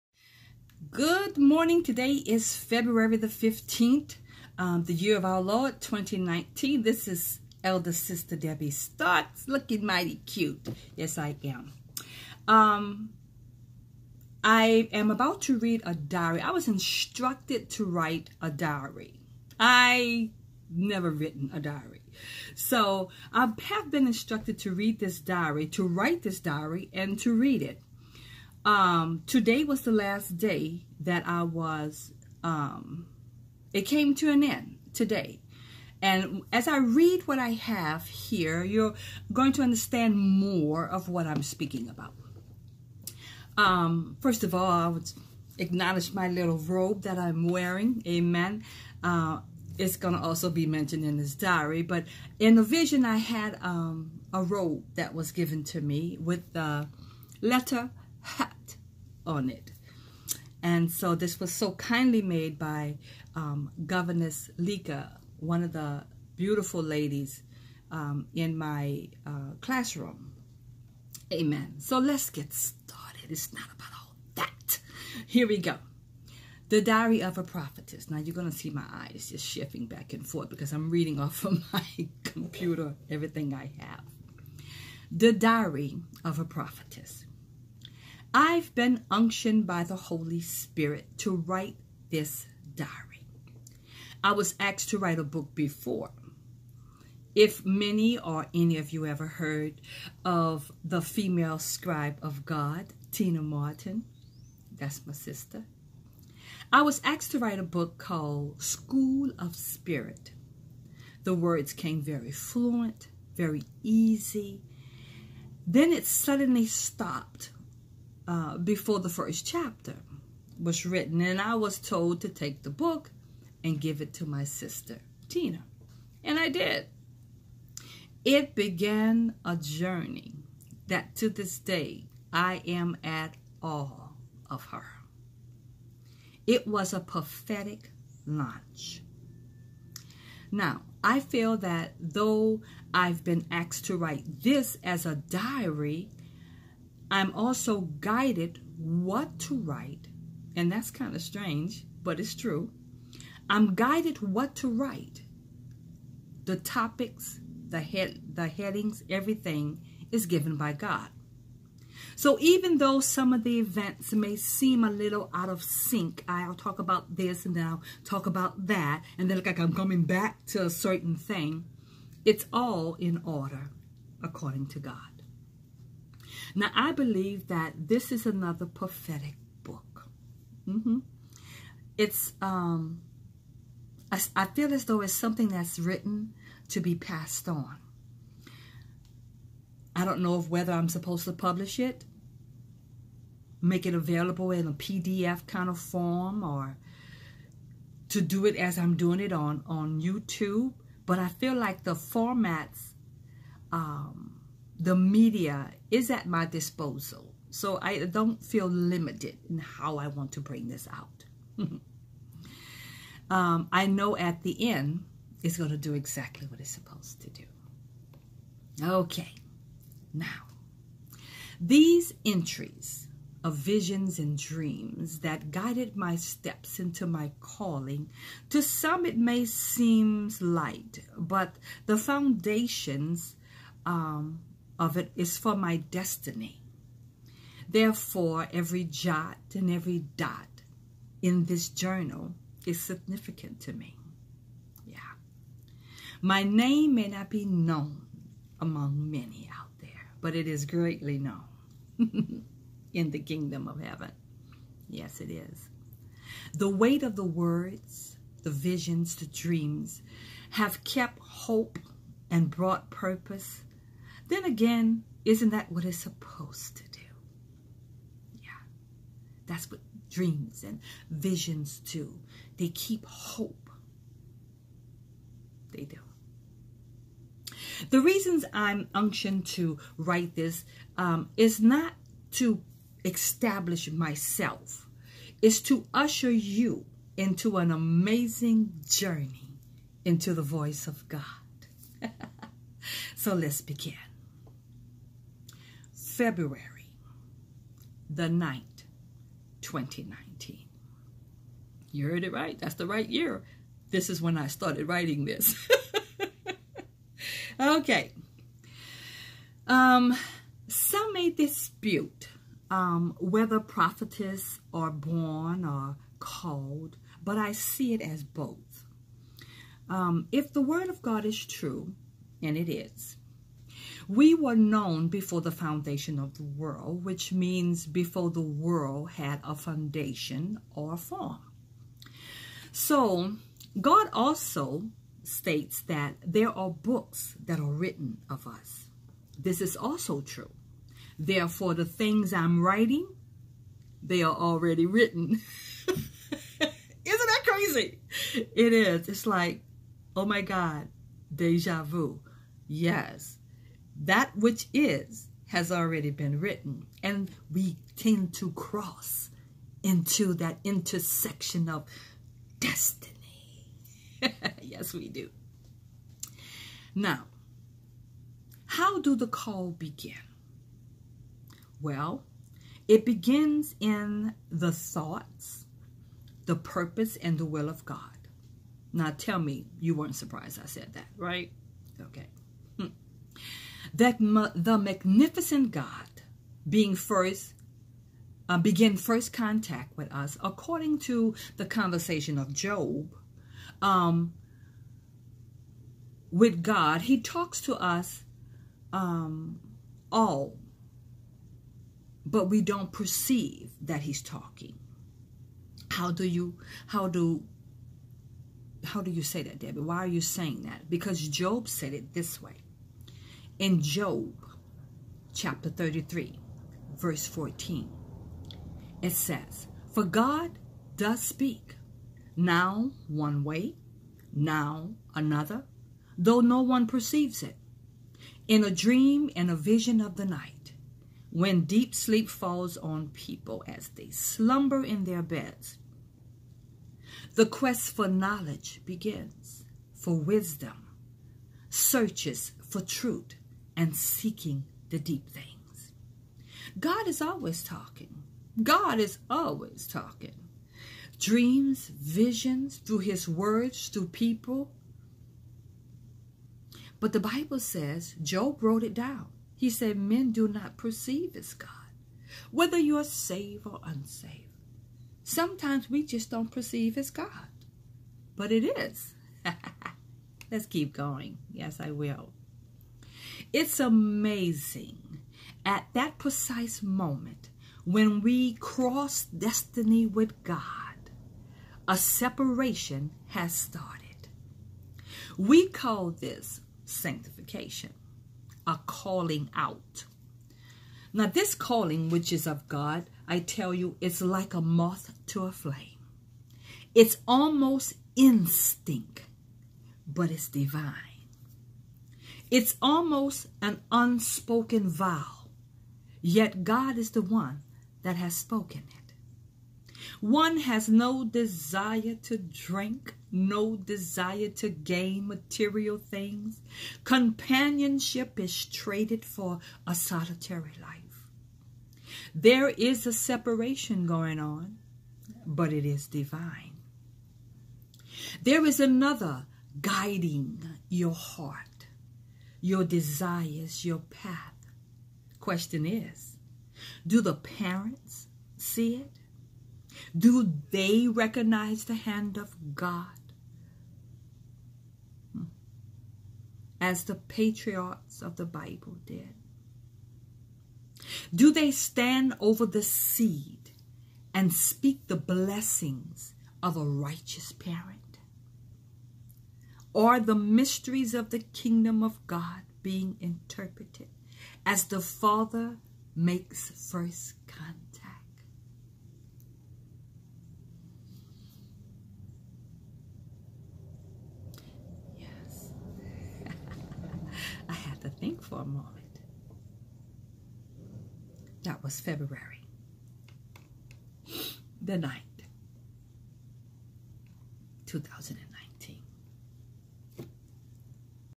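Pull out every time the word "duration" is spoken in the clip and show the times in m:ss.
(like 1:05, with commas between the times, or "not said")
not said.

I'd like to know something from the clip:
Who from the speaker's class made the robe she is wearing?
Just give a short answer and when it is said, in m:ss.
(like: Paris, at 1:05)
Governess Lika, at 1:03.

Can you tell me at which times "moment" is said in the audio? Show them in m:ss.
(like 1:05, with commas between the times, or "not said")
7:56, 9:38.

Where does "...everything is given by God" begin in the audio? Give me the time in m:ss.
2:39.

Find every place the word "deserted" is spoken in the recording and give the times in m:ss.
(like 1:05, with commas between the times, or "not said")
not said.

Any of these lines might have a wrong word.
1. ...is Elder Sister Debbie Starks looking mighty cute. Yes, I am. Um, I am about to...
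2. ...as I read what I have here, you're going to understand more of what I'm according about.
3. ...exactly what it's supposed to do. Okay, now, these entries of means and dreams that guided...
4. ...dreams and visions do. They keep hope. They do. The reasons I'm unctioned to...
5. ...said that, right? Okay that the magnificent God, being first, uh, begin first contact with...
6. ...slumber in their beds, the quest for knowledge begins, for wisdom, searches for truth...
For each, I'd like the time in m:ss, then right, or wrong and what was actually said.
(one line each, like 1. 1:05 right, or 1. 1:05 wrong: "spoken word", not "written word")
1. 0:07 right
2. 0:36 wrong: "speaking", not "according"
3. 3:35 wrong: "visions", not "means"
4. 4:30 right
5. 6:20 right
6. 7:14 right.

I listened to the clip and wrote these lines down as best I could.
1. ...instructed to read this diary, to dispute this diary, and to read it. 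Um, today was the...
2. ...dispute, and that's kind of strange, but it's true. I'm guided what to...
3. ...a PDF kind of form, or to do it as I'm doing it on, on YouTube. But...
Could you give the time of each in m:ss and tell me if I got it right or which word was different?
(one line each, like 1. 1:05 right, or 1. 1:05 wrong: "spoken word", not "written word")
1. 0:24 wrong: "write", not "dispute"
2. 2:29 wrong: "write", not "dispute"
3. 3:14 right.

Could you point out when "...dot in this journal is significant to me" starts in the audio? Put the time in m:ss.
4:00.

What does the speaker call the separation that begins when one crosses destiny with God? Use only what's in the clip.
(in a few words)
sanctification.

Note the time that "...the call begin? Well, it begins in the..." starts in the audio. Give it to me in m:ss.
6:09.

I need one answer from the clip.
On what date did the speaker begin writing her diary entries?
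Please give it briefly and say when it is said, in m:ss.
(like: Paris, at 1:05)
February 9th, 2019, at 4:56.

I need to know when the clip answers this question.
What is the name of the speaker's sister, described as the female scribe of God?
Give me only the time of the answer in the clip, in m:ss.
1:43.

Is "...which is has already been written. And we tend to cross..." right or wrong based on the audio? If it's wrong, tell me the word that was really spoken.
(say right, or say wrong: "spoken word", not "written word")
right.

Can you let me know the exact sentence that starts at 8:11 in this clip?
Now, this calling, which is of God, I tell you, it's like a moth to a flame.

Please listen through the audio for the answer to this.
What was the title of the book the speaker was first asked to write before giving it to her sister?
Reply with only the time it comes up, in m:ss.
1:48.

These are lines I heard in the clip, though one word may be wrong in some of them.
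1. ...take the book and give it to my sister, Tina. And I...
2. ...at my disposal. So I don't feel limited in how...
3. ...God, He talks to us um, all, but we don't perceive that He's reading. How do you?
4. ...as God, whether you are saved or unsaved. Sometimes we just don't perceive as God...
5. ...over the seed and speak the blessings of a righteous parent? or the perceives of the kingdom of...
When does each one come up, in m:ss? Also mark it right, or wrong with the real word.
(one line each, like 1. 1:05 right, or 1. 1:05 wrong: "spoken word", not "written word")
1. 2:02 right
2. 3:26 right
3. 6:36 wrong: "talking", not "reading"
4. 7:41 right
5. 9:12 wrong: "mysteries", not "perceives".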